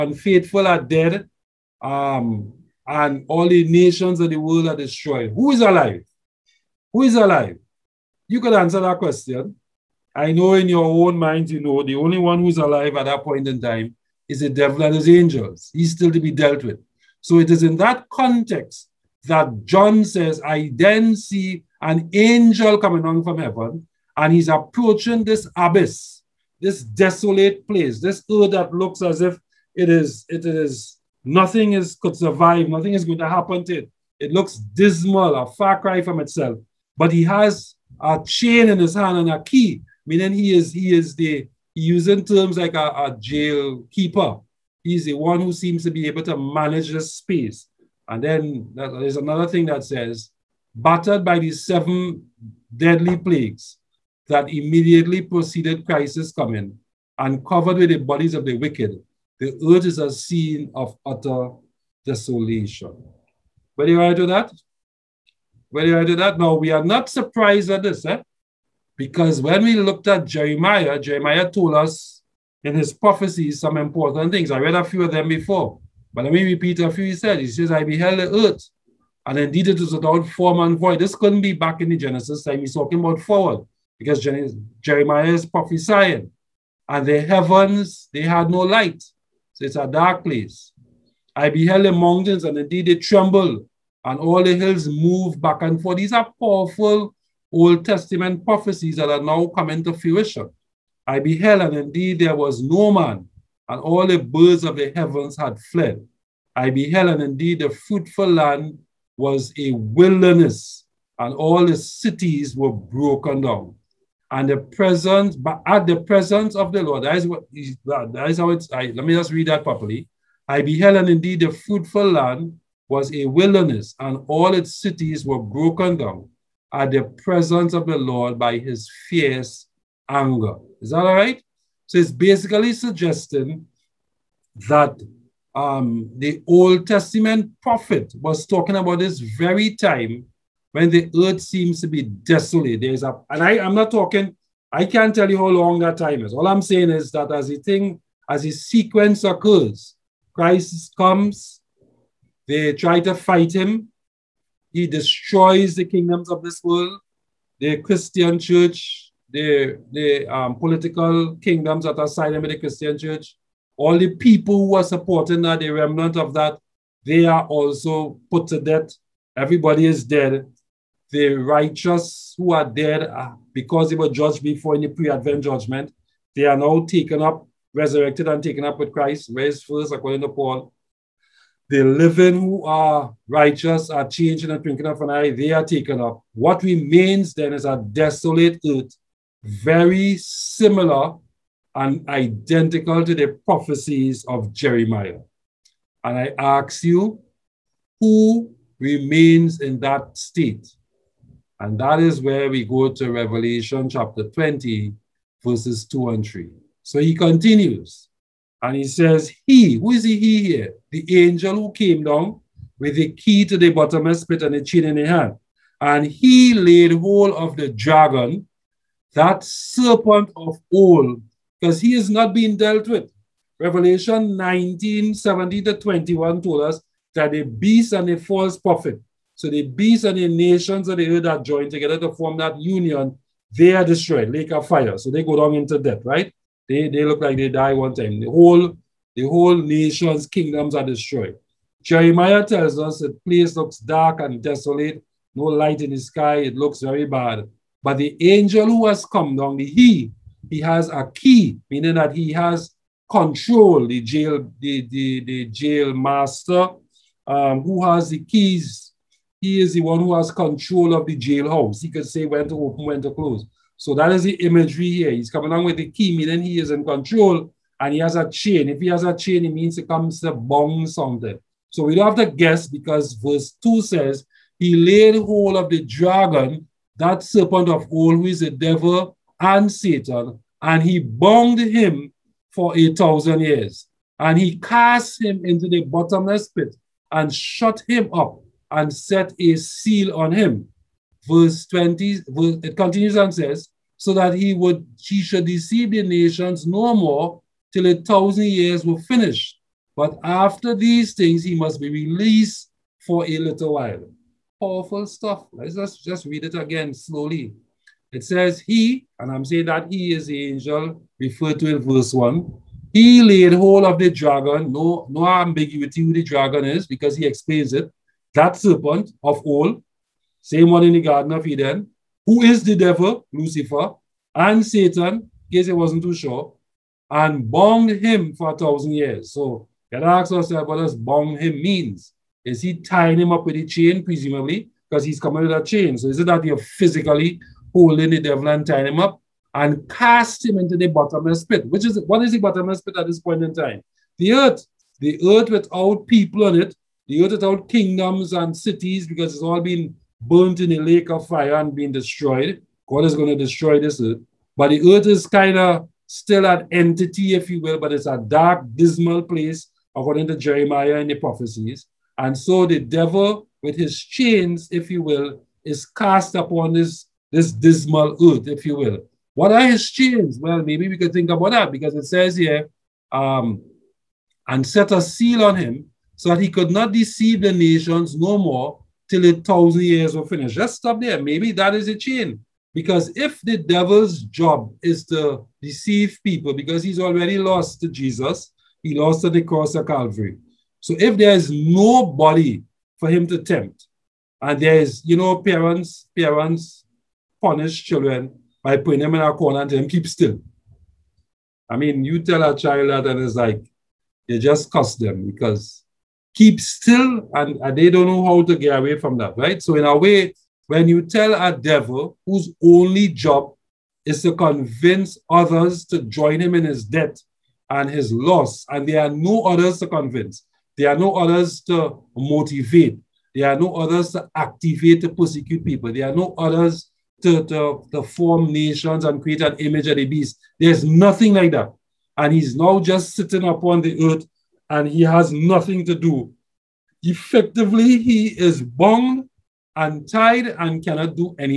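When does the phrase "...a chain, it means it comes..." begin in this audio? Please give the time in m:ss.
4:29.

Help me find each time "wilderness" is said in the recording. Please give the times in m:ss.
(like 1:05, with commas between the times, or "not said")
1:49, 2:03.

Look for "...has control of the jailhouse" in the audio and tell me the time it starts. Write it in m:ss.
4:20.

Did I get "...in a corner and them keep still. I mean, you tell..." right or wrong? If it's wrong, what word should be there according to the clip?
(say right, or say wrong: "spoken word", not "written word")
right.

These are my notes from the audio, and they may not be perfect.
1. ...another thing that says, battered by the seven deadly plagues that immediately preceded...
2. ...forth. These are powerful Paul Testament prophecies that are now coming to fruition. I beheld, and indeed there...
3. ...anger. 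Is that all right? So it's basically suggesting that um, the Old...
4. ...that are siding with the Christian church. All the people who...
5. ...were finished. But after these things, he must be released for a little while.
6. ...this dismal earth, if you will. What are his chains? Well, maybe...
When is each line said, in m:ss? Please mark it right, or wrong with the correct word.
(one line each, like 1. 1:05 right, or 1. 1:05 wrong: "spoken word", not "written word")
1. 0:49 right
2. 1:35 wrong: "Old", not "Paul"
3. 2:10 right
4. 2:41 right
5. 4:58 right
6. 6:07 right.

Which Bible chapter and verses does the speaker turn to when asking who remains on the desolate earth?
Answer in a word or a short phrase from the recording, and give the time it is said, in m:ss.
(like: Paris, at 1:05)
Revelation 20:2-3, at 3:23.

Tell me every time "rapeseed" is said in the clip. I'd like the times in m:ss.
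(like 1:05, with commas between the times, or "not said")
not said.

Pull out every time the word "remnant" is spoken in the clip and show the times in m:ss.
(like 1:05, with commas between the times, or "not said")
2:45.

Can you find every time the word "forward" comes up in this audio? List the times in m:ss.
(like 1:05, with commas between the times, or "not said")
1:23.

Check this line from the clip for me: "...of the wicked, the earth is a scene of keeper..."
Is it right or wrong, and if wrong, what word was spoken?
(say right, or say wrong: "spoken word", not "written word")
wrong: "utter", not "keeper".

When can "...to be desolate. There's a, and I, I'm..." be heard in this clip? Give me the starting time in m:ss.
2:21.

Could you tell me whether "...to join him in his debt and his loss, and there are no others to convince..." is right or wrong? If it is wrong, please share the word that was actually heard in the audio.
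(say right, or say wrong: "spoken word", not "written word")
right.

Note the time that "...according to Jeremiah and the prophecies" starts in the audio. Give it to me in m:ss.
5:59.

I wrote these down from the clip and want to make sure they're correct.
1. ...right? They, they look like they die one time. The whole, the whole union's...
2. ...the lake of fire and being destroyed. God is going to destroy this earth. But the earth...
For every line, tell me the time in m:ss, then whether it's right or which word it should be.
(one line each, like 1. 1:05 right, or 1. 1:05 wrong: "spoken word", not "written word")
1. 3:56 wrong: "nation", not "union"
2. 5:50 right.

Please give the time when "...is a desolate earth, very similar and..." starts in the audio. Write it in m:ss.
3:07.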